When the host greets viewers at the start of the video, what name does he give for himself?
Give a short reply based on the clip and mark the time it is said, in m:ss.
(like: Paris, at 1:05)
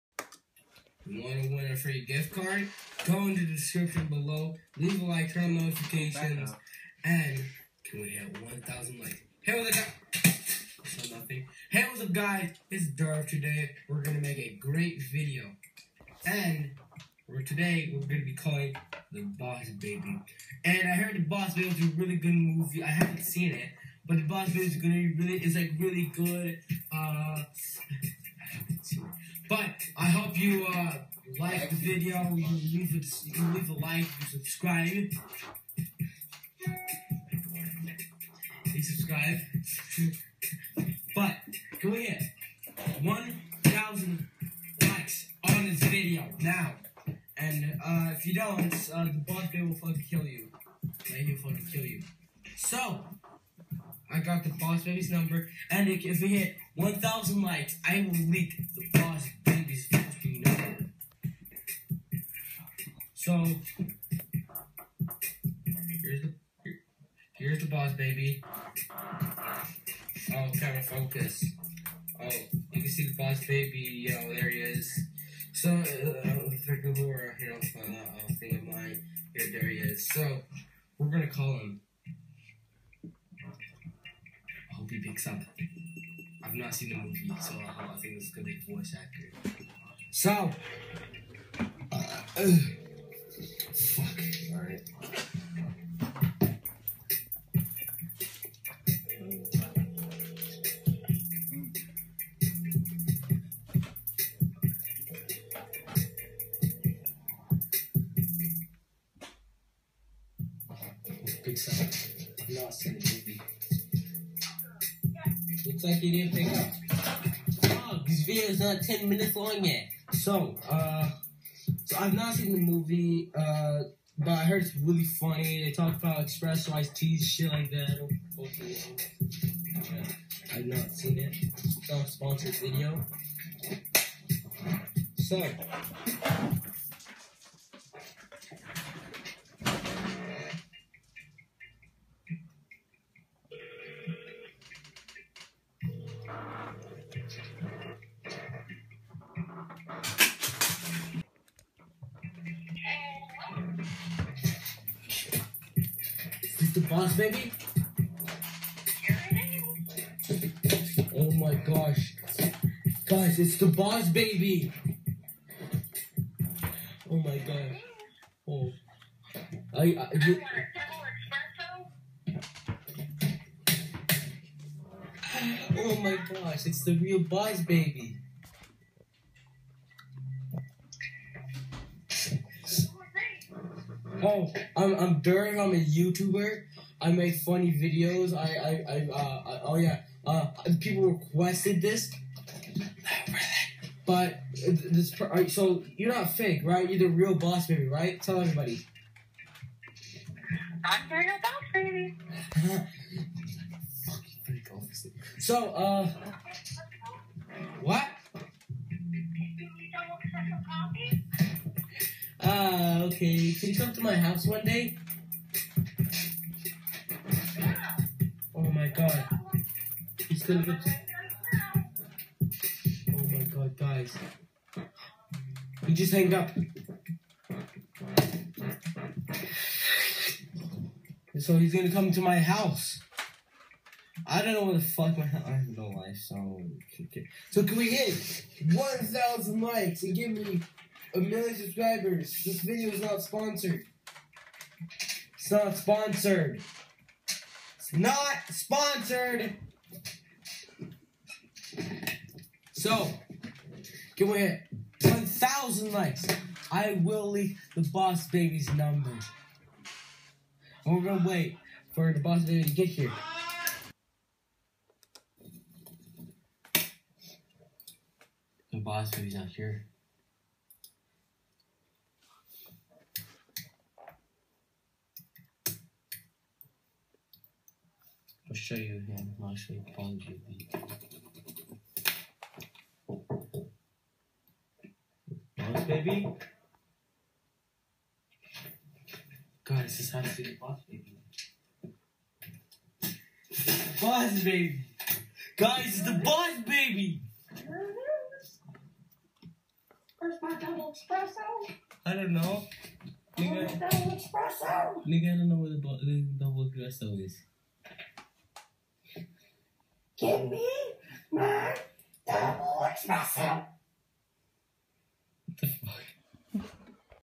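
Darth, at 0:12.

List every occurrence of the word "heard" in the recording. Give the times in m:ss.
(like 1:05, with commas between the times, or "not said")
0:20, 2:04.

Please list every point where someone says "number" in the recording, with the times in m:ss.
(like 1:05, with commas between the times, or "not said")
0:55, 4:18.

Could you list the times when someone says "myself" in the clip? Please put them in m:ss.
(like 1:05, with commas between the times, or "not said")
5:13.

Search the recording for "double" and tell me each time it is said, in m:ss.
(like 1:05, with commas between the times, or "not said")
5:00, 5:06.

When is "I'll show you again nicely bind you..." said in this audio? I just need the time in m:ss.
4:38.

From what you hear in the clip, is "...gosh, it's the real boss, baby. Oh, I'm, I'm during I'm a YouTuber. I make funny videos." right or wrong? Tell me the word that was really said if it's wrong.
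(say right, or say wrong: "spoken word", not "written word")
right.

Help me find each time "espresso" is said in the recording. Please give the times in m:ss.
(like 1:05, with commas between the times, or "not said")
5:00, 5:06.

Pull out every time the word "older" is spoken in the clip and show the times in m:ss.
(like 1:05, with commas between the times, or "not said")
not said.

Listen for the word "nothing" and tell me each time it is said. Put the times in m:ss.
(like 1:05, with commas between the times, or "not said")
0:11.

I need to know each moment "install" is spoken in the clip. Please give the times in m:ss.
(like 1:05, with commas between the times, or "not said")
not said.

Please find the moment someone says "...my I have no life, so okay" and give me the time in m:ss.
3:55.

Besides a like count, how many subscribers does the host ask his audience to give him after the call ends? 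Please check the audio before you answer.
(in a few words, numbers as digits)
a million.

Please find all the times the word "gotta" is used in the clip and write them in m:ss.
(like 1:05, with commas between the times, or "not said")
1:10.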